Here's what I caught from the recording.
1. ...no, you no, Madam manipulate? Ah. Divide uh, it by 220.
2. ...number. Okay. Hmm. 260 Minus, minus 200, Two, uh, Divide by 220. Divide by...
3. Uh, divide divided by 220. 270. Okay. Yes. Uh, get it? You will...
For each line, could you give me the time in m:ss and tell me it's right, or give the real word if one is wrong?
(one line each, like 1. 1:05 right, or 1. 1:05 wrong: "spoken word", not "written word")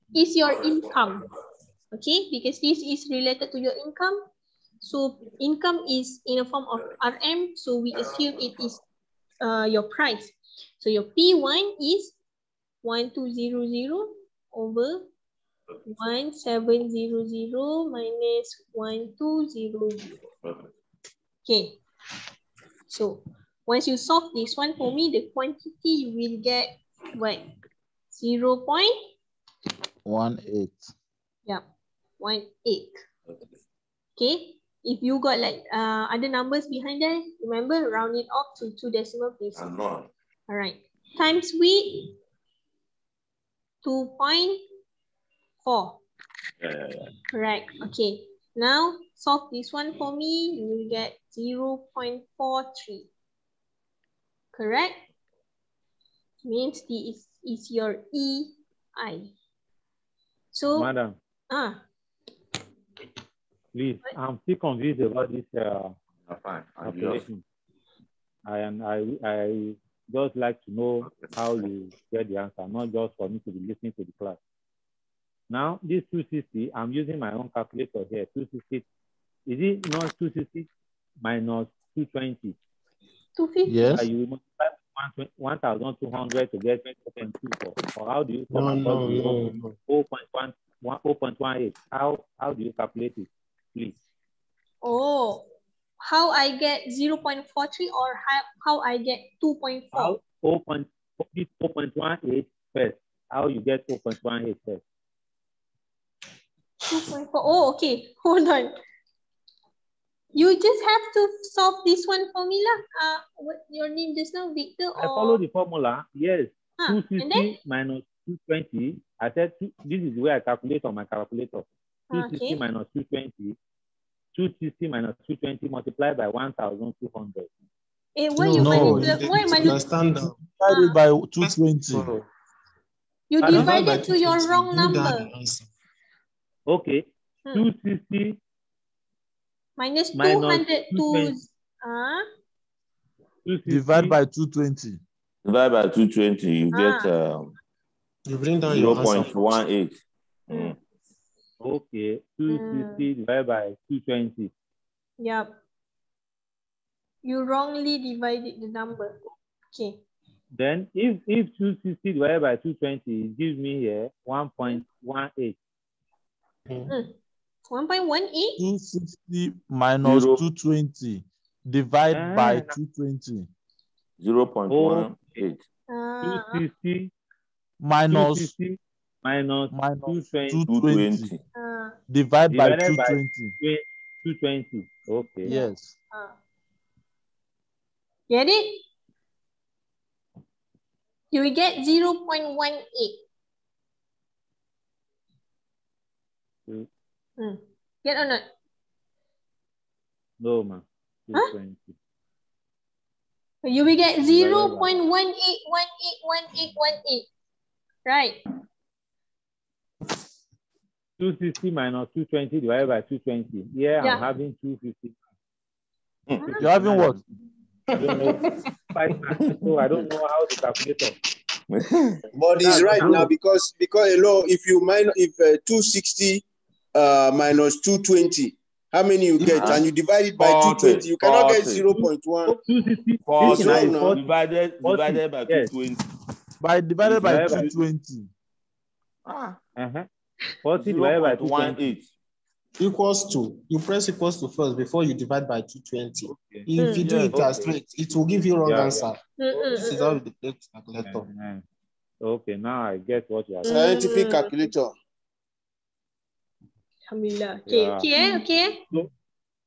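1. 2:08 wrong: "Why", not "Madam"
2. 2:14 right
3. 3:01 wrong: "220", not "270".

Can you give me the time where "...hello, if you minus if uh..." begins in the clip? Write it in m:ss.
3:44.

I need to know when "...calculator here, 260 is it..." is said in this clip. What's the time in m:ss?
1:17.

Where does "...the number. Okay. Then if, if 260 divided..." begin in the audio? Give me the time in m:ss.
2:38.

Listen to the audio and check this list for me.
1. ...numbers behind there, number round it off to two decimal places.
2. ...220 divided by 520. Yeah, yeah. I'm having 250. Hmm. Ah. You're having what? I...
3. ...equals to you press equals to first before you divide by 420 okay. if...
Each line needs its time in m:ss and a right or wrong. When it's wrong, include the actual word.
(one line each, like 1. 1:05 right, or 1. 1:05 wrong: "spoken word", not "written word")
1. 0:36 wrong: "remember", not "number"
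2. 3:32 wrong: "220", not "520"
3. 4:02 wrong: "220", not "420".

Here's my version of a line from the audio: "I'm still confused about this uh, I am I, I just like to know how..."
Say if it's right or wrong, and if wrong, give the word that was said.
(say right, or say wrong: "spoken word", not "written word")
right.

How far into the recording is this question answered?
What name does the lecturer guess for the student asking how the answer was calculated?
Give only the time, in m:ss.
1:54.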